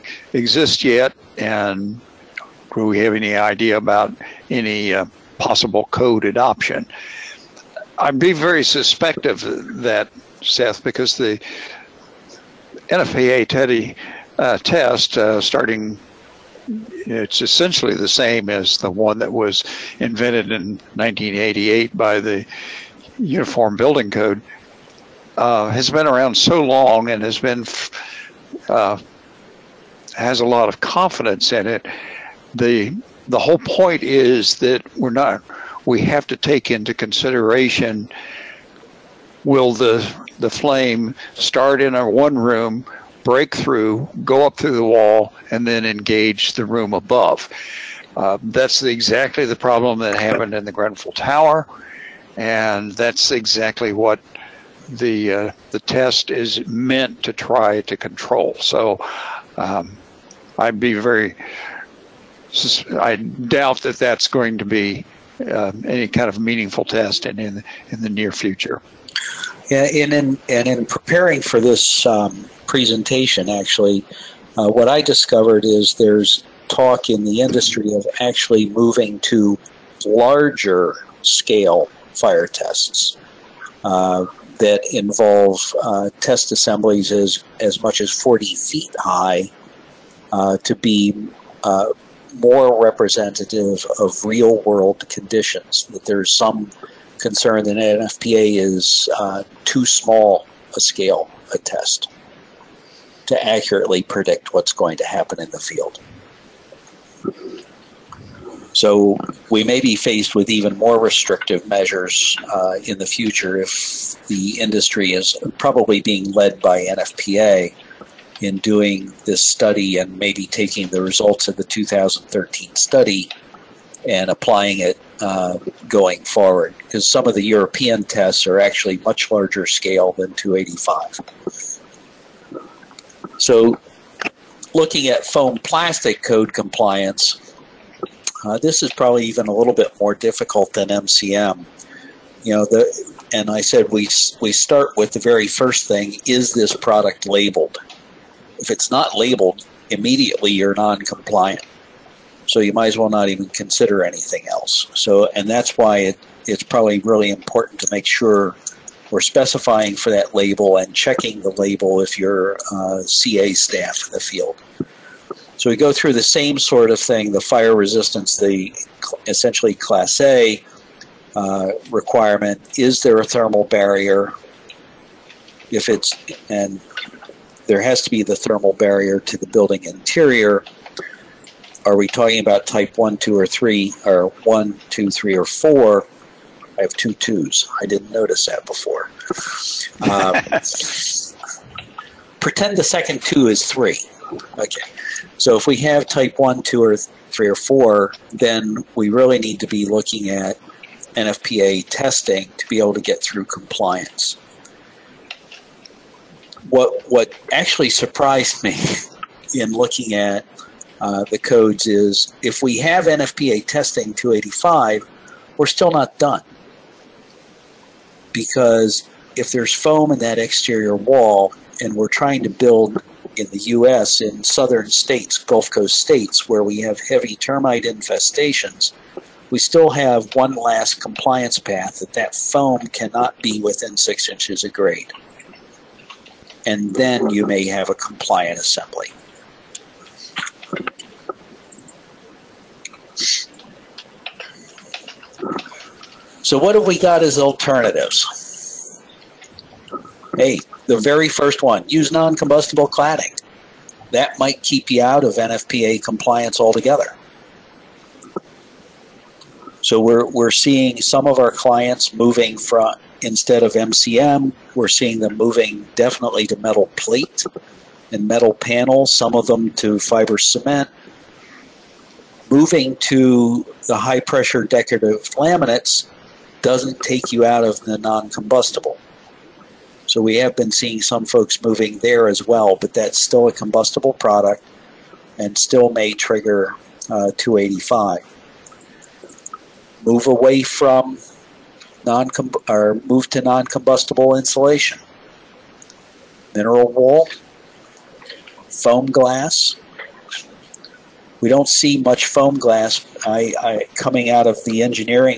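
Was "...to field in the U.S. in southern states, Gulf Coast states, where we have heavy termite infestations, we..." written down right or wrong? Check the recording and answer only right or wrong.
wrong.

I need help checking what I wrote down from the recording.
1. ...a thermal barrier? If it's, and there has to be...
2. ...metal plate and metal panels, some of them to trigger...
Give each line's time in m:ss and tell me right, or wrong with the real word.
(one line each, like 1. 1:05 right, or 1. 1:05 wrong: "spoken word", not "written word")
1. 2:53 right
2. 4:26 wrong: "fiber", not "trigger".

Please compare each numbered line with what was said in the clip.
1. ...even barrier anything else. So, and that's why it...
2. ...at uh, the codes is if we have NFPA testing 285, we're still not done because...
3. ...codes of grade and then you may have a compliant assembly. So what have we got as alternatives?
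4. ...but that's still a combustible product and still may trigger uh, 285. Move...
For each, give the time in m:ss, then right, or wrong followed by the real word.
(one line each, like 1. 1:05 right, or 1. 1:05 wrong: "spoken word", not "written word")
1. 2:33 wrong: "consider", not "barrier"
2. 3:30 right
3. 3:54 wrong: "inches", not "codes"
4. 4:42 right.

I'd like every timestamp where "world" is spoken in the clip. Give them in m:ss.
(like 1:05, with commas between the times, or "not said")
1:34.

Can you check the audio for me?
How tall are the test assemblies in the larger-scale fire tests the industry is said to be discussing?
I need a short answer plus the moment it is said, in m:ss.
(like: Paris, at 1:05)
40 feet, at 1:28.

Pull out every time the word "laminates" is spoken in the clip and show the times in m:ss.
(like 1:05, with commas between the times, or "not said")
4:35.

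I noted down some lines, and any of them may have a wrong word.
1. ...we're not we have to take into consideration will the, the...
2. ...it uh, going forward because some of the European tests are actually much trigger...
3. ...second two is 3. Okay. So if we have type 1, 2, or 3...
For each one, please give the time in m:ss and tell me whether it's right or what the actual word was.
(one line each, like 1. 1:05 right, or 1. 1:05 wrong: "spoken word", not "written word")
1. 0:34 right
2. 2:04 wrong: "larger", not "trigger"
3. 3:12 right.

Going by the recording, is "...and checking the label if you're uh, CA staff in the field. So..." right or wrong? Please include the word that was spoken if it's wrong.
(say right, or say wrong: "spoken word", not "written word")
right.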